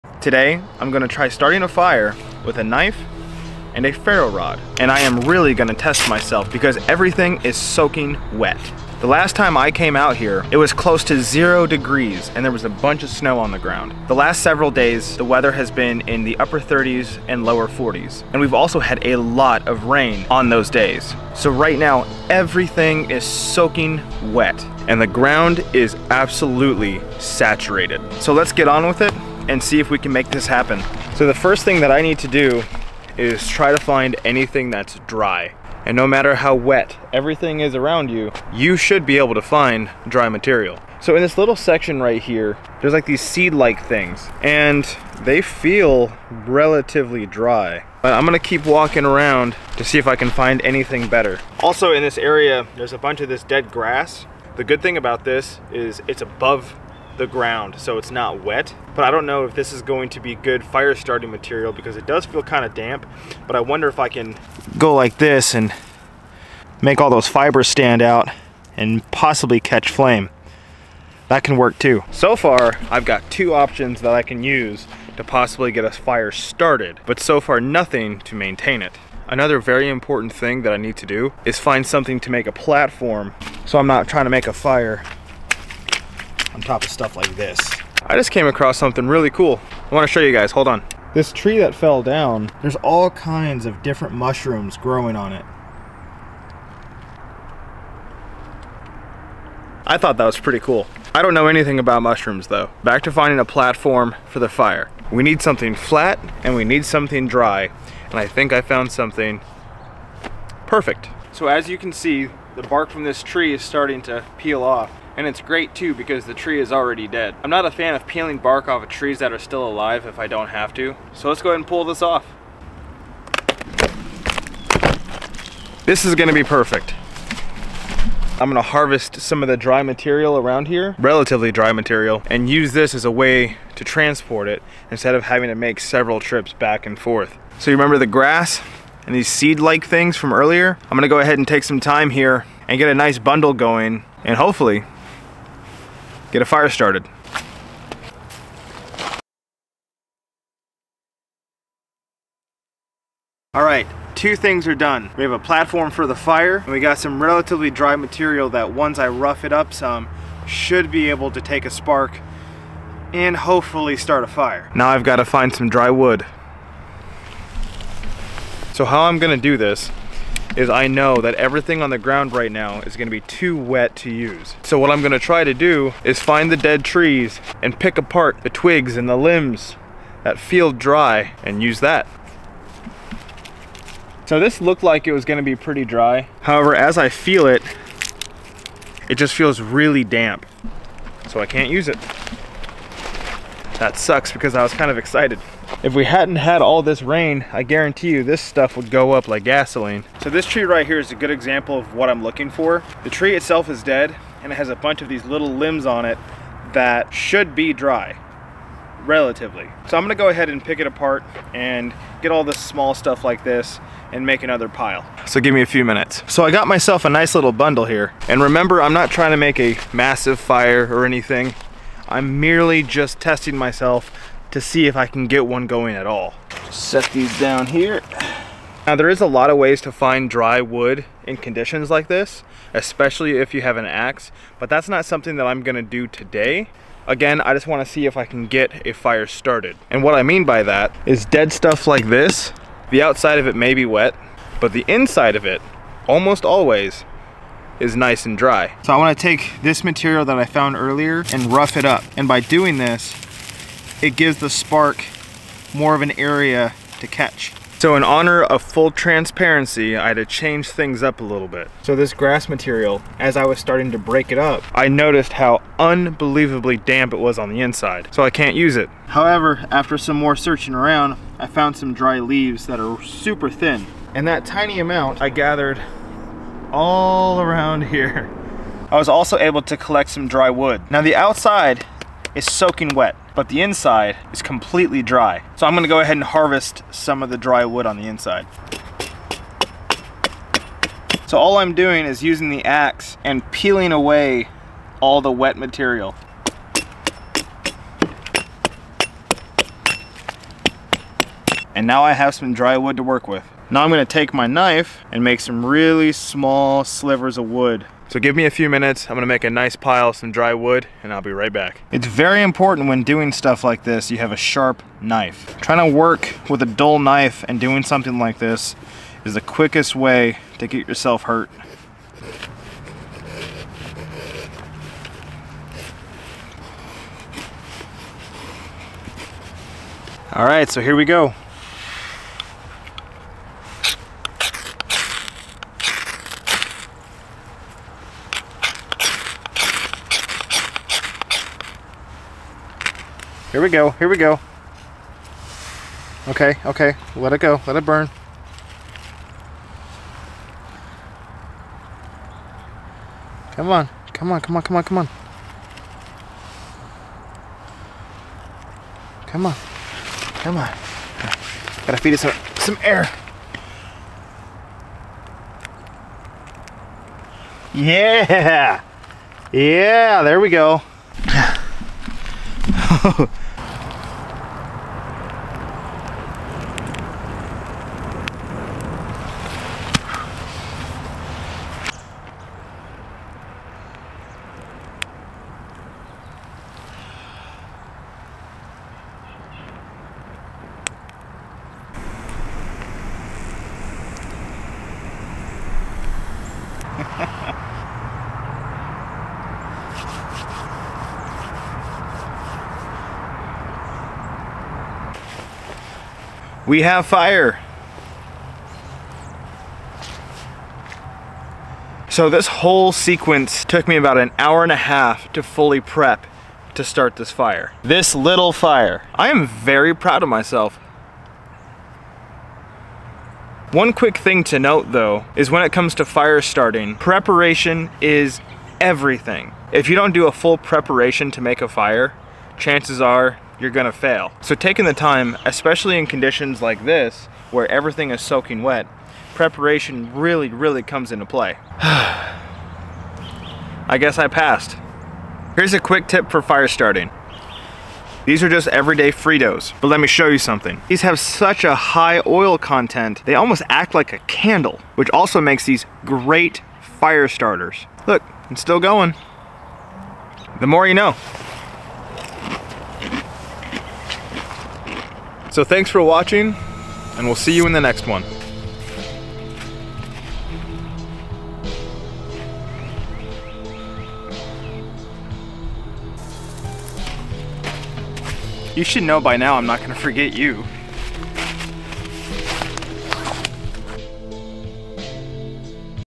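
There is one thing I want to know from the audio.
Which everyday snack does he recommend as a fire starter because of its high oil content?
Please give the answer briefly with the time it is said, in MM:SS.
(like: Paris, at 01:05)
Fritos, at 07:29.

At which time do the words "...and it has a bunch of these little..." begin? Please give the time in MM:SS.
03:24.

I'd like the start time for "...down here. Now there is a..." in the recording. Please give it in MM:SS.
03:47.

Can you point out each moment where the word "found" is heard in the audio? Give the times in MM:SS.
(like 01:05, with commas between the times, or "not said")
01:48, 04:10, 04:31.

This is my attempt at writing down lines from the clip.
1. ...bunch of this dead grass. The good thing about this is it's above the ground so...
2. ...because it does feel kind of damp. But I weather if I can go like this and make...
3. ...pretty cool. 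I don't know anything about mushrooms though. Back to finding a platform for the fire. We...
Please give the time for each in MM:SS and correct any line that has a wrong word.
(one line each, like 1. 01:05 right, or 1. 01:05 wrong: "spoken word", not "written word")
1. 00:52 right
2. 01:01 wrong: "wonder", not "weather"
3. 01:40 right.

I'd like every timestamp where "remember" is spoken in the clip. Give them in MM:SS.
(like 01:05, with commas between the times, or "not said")
02:17, 03:38.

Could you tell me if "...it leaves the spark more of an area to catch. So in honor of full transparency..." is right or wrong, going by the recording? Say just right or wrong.
wrong.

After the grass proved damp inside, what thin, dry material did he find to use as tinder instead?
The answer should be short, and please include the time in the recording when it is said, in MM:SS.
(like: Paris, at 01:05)
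dry leaves, at 04:31.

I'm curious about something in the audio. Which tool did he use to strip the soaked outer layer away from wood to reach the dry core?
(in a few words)
the ax.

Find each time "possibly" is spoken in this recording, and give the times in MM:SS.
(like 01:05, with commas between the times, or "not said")
01:09, 01:15.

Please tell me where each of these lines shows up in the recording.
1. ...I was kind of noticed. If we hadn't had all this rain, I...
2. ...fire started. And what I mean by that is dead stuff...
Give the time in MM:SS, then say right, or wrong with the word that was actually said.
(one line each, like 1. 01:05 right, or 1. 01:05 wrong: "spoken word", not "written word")
1. 03:14 wrong: "excited", not "noticed"
2. 03:58 right.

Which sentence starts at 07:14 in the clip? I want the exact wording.
So taking the time, especially in conditions like this, where everything is soaking wet, preparation really, really comes into play.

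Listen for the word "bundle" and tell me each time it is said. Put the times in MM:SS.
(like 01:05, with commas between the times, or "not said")
02:23, 03:37.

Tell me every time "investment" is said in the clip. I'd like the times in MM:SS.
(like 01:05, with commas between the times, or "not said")
not said.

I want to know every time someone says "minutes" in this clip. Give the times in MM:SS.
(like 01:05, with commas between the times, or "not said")
03:35, 05:08.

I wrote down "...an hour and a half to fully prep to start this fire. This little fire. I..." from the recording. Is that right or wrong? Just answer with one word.
right.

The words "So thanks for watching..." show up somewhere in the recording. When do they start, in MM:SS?
07:45.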